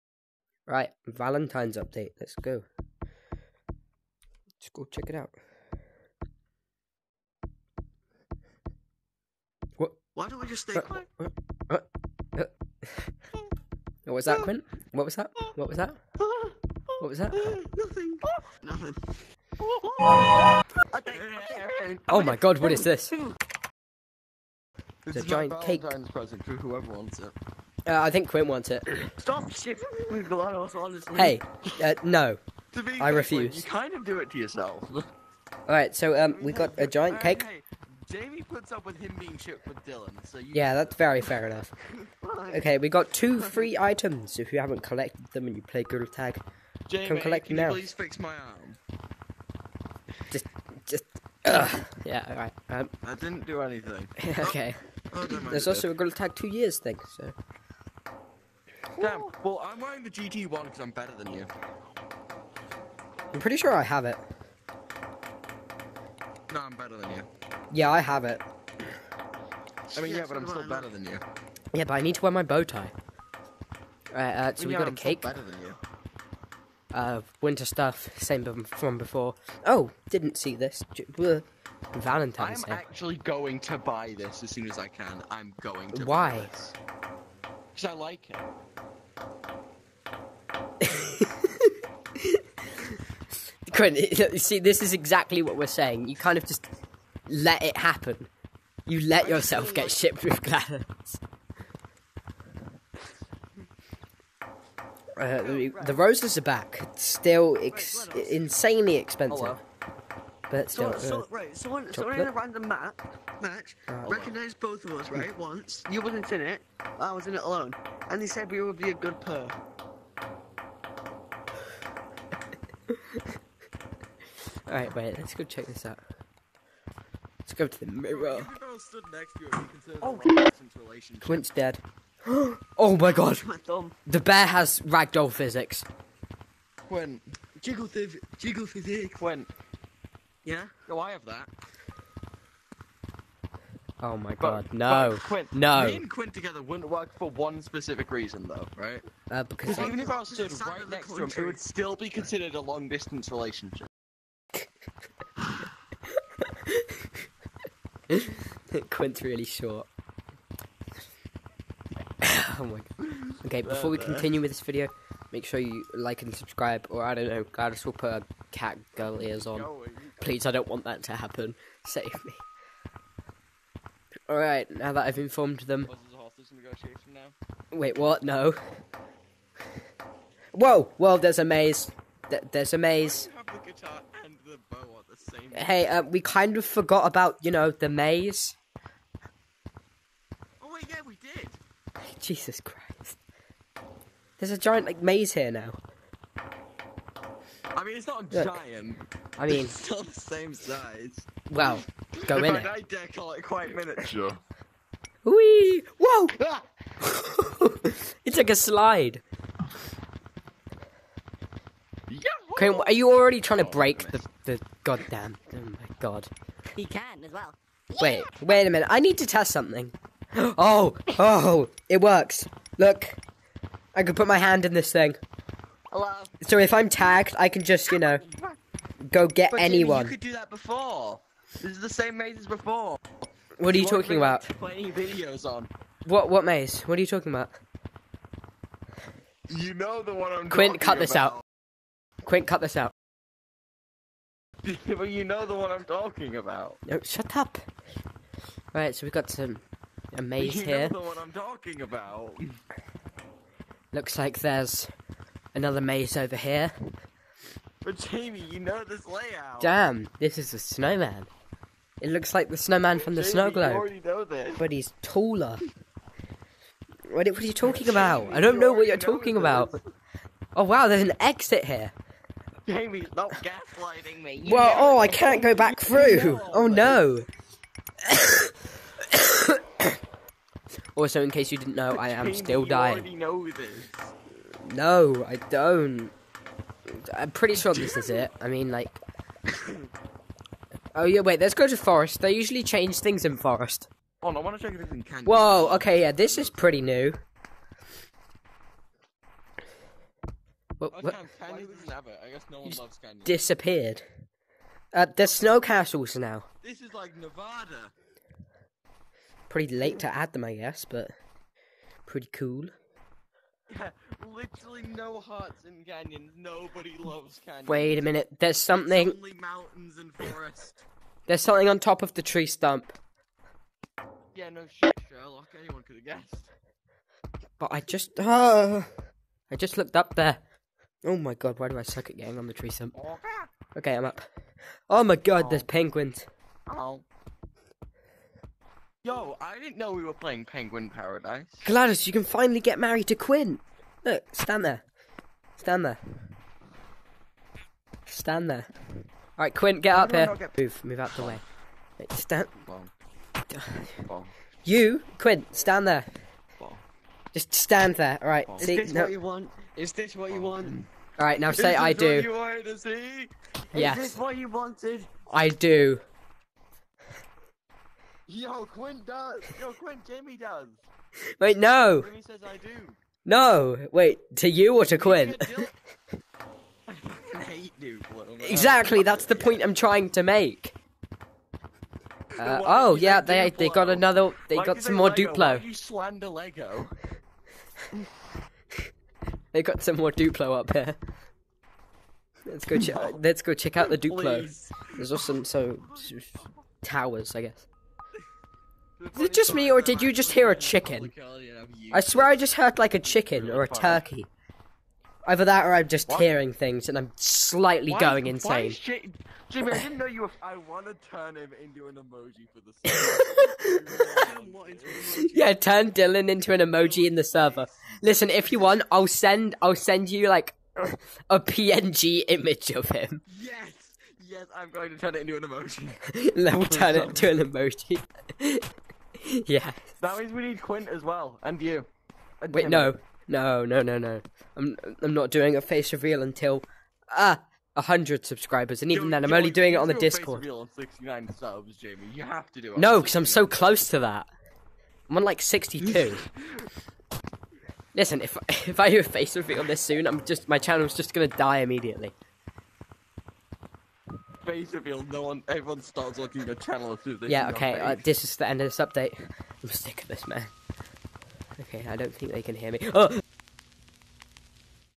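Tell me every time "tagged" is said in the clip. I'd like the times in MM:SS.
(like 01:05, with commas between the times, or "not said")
03:46.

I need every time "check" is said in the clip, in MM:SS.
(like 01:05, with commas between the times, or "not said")
00:04, 02:05, 04:54, 06:33.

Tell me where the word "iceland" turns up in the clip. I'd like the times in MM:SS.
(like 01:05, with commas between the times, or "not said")
not said.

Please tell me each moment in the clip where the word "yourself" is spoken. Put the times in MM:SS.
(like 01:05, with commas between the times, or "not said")
00:34, 01:39.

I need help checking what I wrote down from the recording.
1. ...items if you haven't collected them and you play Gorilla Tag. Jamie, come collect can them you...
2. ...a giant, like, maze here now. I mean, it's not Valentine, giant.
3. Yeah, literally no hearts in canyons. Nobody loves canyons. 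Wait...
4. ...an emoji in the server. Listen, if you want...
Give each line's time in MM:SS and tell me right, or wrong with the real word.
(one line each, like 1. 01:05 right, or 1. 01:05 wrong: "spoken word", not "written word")
1. 00:43 right
2. 03:14 wrong: "Look", not "Valentine"
3. 05:13 right
4. 06:56 right.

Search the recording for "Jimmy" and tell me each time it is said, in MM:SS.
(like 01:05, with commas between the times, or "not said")
03:50, 06:49.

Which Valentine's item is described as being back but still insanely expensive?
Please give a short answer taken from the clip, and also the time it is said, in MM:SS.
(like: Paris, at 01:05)
roses, at 01:45.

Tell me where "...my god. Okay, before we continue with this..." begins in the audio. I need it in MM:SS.
02:42.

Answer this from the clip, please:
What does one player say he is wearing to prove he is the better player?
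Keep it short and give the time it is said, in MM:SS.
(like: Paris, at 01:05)
GT1, at 01:00.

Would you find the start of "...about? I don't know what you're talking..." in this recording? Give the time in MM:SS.
04:27.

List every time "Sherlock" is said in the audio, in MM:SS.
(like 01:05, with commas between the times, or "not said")
05:25.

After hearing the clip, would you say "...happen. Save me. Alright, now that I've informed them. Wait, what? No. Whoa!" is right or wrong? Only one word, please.
right.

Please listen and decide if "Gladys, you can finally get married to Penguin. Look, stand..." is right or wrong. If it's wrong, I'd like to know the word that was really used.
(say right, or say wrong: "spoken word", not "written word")
wrong: "Quint", not "Penguin".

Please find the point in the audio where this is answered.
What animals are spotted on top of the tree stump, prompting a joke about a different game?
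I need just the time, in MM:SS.
05:35.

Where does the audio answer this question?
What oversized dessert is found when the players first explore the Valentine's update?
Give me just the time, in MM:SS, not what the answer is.
00:25.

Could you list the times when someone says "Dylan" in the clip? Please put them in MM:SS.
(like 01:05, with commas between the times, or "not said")
00:39, 06:55.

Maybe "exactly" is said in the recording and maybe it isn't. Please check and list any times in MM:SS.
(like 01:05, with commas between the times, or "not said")
01:34, 06:18.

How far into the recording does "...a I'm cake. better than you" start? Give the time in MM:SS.
01:14.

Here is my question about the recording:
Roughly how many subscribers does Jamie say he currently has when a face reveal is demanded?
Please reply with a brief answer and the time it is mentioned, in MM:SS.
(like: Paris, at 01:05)
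62, at 07:25.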